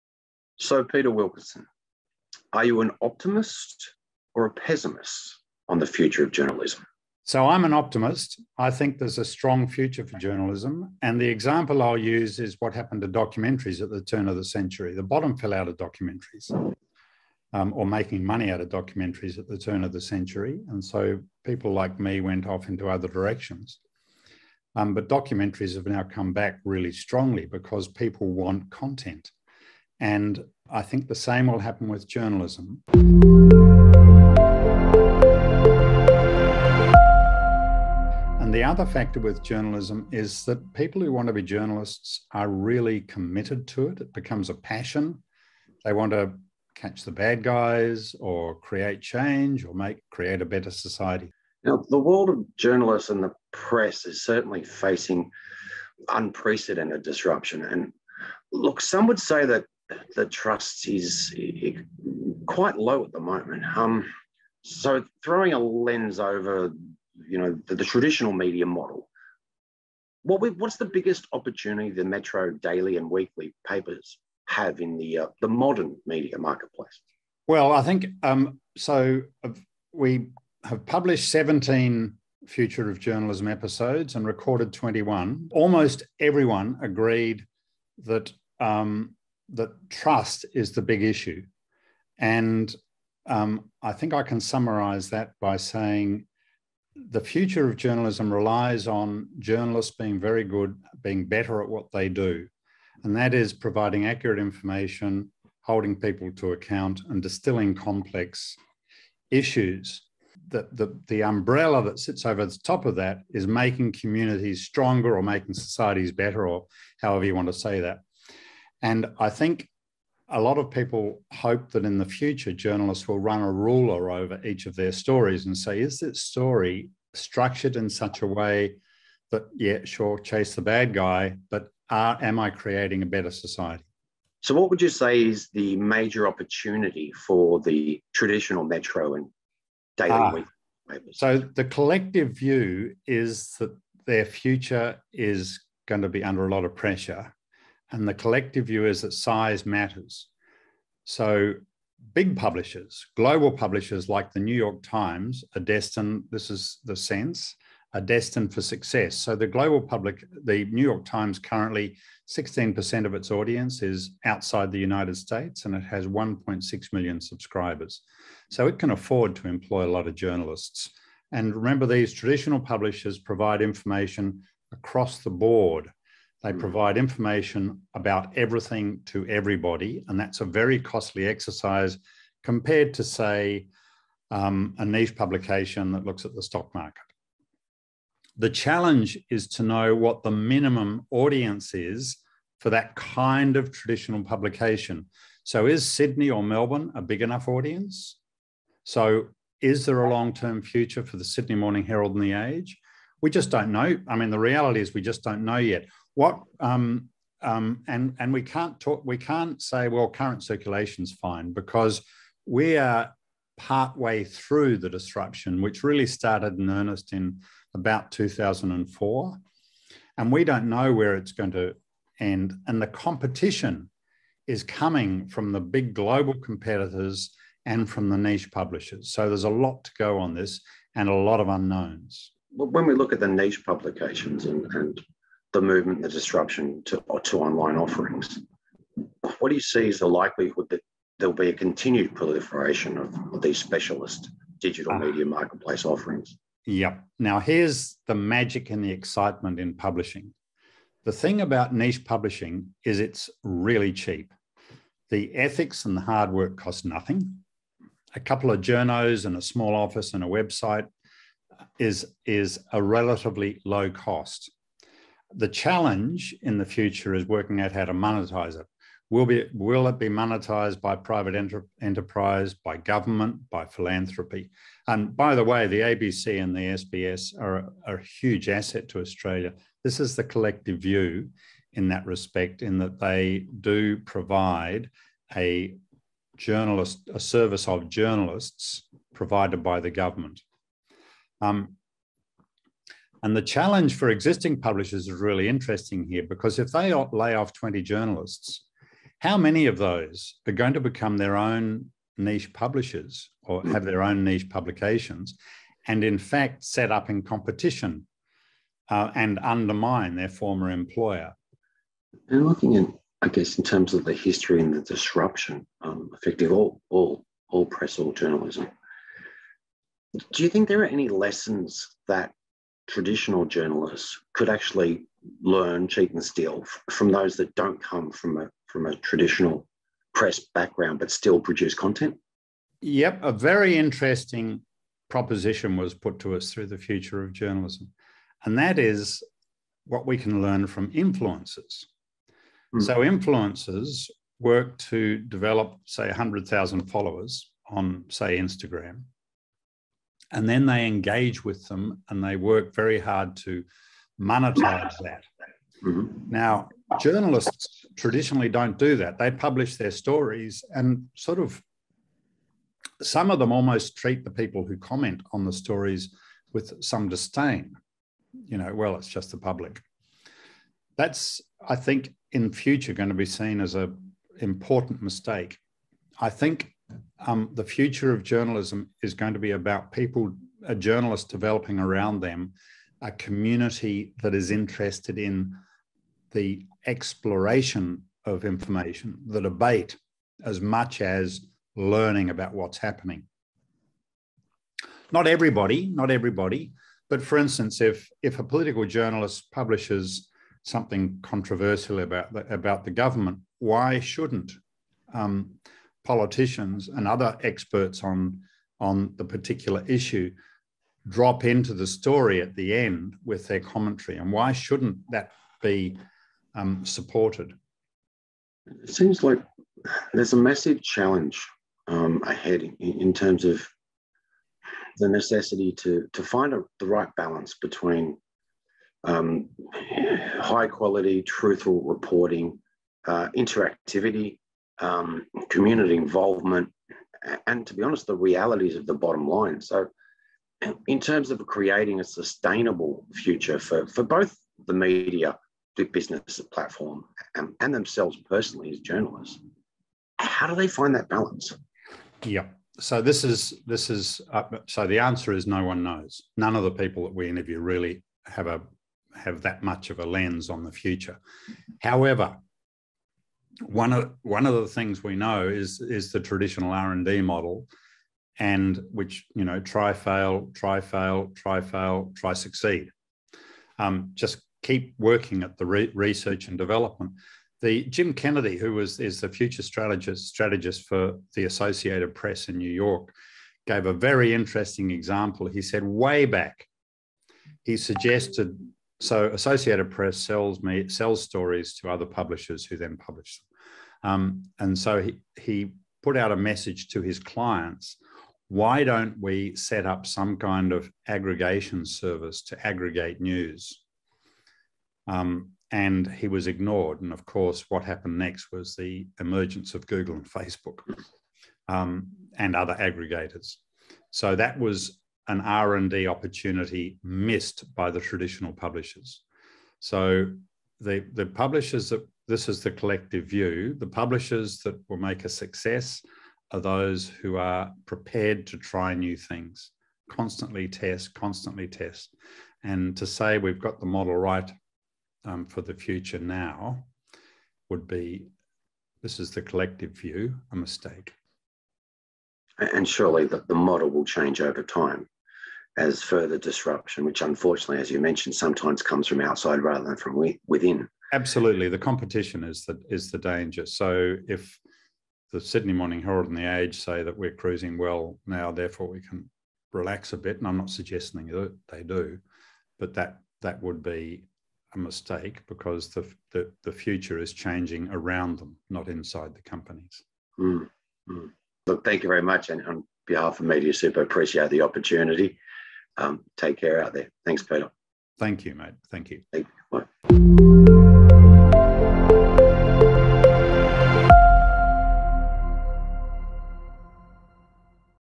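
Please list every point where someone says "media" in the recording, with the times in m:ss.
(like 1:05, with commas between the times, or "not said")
1:08, 1:16, 4:04, 7:24, 9:33.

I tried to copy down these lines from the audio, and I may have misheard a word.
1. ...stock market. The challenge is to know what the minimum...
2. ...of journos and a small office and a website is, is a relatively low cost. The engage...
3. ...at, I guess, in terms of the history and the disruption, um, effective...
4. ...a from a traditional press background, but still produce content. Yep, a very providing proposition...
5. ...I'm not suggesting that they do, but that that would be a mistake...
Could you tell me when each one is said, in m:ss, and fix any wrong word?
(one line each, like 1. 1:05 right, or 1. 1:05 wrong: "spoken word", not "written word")
1. 3:06 right
2. 4:18 wrong: "challenge", not "engage"
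3. 5:12 right
4. 5:28 wrong: "interesting", not "providing"
5. 9:20 right.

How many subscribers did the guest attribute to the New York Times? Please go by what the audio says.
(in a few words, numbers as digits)
1.6 million.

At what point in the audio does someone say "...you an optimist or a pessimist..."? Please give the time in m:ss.
0:02.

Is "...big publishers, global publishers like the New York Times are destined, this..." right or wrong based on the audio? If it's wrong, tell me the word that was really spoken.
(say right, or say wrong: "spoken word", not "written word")
right.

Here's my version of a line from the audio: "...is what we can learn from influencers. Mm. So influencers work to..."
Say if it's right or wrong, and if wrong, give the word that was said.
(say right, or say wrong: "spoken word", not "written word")
right.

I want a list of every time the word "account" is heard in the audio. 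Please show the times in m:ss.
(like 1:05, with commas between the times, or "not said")
1:46.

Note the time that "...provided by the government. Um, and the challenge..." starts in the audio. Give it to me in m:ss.
4:49.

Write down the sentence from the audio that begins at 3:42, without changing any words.
And the competition is coming from the big global competitors and from the niche publishers.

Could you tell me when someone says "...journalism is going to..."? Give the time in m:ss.
6:18.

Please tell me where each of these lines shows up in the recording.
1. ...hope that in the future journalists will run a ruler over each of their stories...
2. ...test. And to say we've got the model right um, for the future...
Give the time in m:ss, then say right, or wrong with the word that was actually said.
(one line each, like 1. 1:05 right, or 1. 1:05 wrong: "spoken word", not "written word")
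1. 2:01 right
2. 8:51 right.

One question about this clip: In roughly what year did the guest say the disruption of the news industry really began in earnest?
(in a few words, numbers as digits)
2004.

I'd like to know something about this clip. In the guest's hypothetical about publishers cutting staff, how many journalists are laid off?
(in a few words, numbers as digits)
20.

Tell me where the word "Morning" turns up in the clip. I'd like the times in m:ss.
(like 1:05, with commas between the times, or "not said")
3:21, 9:15.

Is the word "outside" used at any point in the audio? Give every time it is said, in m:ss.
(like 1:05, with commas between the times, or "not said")
2:44, 9:09.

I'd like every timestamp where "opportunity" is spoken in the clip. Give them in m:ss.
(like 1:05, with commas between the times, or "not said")
1:11, 2:16, 8:36, 9:34.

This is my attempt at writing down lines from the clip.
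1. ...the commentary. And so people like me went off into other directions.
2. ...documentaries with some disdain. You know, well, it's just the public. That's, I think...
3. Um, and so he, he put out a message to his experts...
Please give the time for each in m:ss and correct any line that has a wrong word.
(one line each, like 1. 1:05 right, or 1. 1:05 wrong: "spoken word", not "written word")
1. 0:19 wrong: "century", not "commentary"
2. 6:05 wrong: "stories", not "documentaries"
3. 8:14 wrong: "clients", not "experts".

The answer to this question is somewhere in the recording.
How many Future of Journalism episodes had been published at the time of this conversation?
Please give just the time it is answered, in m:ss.
1:21.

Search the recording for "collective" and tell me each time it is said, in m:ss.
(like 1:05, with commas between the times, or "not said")
2:21, 2:28, 4:40, 8:42, 8:59.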